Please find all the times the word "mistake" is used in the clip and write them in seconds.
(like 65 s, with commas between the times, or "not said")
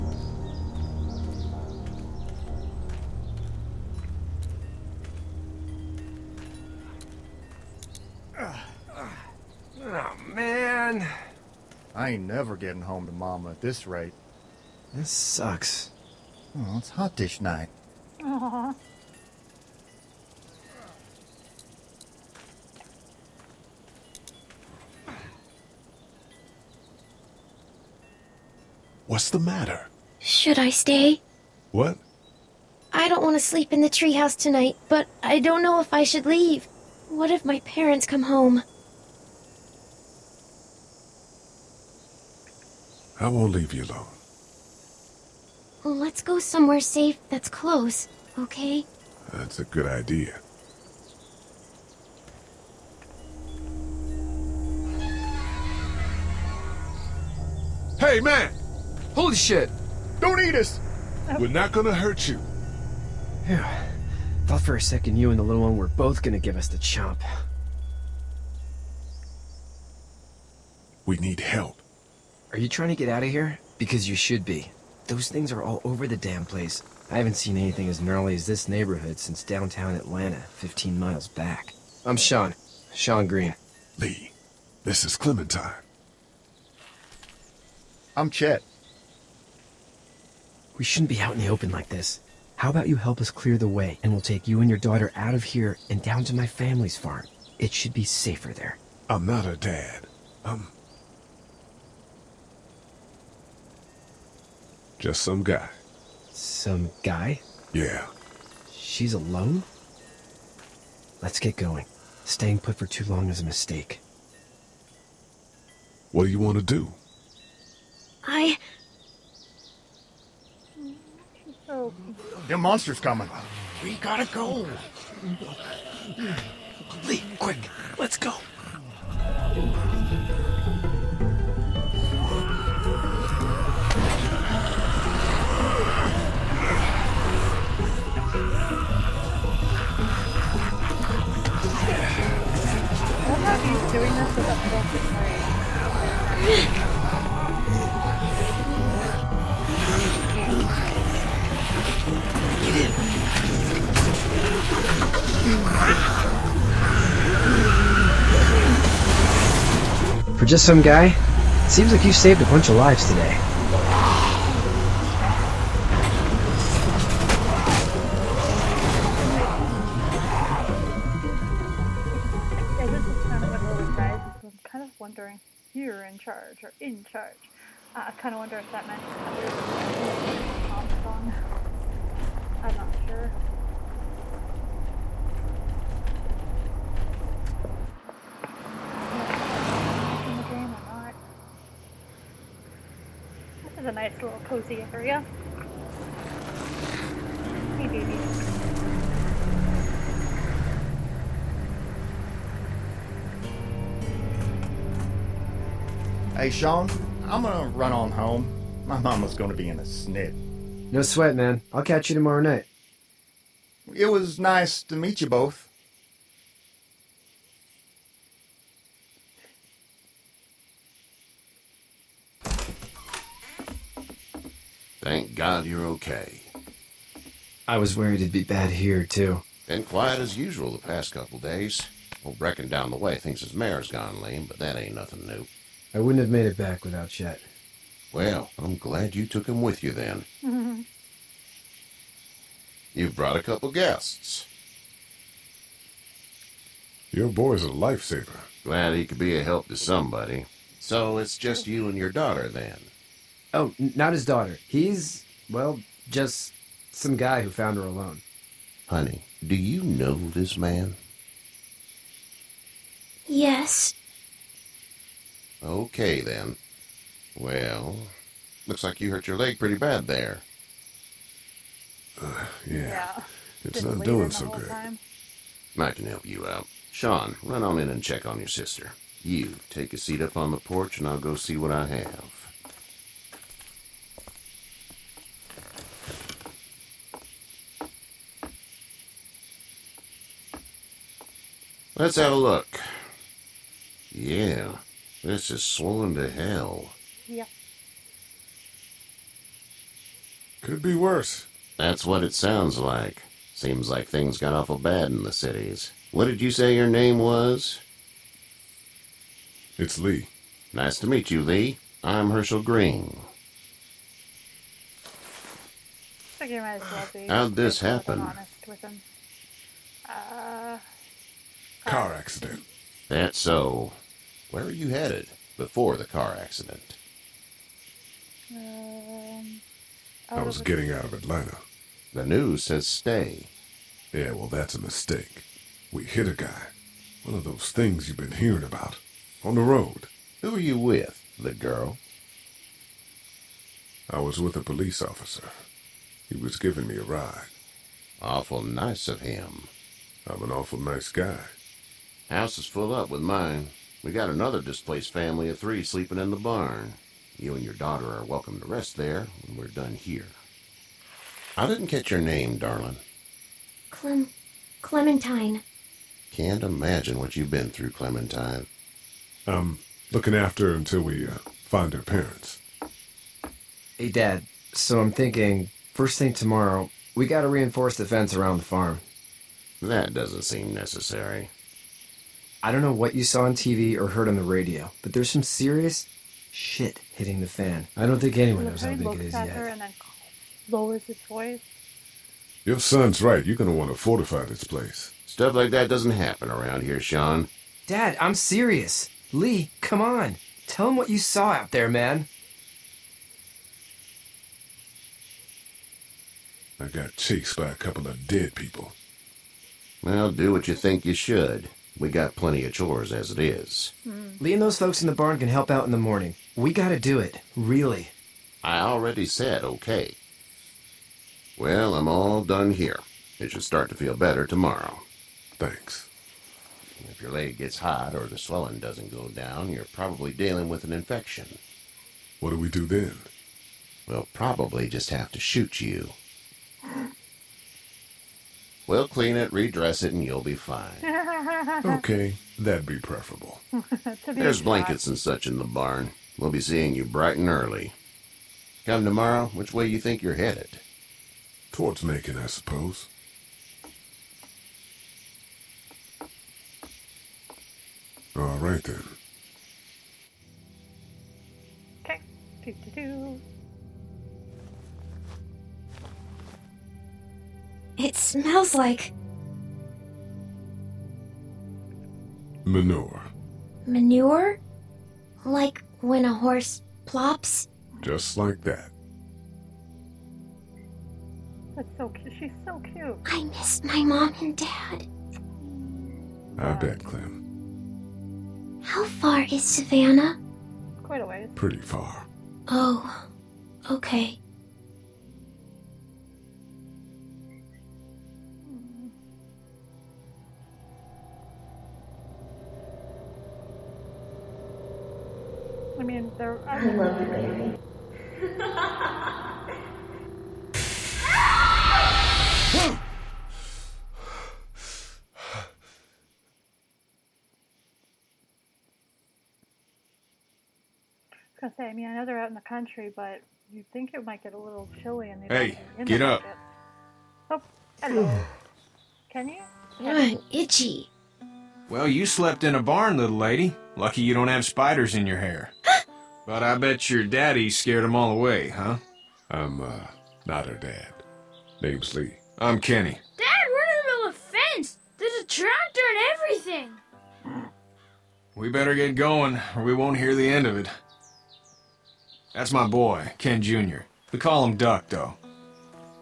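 113 s, 334 s.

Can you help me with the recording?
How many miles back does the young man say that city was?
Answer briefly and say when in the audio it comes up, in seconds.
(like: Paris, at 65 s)
15, at 80 s.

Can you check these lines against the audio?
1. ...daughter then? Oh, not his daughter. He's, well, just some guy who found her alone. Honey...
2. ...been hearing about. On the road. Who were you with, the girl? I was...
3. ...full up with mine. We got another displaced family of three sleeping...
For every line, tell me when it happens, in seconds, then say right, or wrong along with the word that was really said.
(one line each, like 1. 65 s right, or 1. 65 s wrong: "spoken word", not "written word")
1. 252 s right
2. 338 s right
3. 352 s right.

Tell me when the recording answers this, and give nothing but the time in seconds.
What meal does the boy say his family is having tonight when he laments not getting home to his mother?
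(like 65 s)
16 s.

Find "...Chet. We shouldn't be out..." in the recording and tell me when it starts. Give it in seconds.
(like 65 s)
88 s.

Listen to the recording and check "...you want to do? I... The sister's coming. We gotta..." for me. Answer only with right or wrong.
wrong.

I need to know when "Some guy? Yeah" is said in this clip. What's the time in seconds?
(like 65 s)
106 s.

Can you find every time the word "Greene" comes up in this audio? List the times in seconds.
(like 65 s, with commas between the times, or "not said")
83 s, 312 s.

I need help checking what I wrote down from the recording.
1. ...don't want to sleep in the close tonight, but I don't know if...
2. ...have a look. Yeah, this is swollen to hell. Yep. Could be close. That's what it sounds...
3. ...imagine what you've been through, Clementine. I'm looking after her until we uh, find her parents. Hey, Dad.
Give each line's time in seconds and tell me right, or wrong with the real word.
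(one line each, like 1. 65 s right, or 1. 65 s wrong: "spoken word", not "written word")
1. 33 s wrong: "treehouse", not "close"
2. 292 s wrong: "worse", not "close"
3. 366 s right.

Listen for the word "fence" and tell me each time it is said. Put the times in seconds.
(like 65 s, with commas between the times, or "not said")
378 s, 544 s.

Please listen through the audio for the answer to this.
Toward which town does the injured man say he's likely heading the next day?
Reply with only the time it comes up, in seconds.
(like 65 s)
452 s.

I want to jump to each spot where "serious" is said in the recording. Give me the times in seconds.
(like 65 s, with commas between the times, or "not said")
385 s, 398 s.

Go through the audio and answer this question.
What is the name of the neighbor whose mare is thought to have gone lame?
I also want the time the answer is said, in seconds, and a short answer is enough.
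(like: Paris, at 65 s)
Brecken, at 232 s.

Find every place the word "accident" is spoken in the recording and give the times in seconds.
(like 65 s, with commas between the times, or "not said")
322 s, 326 s.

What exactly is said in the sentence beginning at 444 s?
There's blankets and such in the barn.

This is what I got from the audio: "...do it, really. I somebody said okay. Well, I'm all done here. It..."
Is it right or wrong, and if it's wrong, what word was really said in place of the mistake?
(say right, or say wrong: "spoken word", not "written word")
wrong: "already", not "somebody".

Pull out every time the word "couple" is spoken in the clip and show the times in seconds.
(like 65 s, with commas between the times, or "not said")
231 s, 243 s, 407 s.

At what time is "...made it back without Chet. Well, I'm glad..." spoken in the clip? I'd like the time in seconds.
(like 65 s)
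236 s.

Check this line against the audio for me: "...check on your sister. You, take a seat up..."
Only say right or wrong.
right.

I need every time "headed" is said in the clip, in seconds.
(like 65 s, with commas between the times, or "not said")
324 s, 450 s.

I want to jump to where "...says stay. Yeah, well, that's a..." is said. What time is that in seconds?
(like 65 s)
332 s.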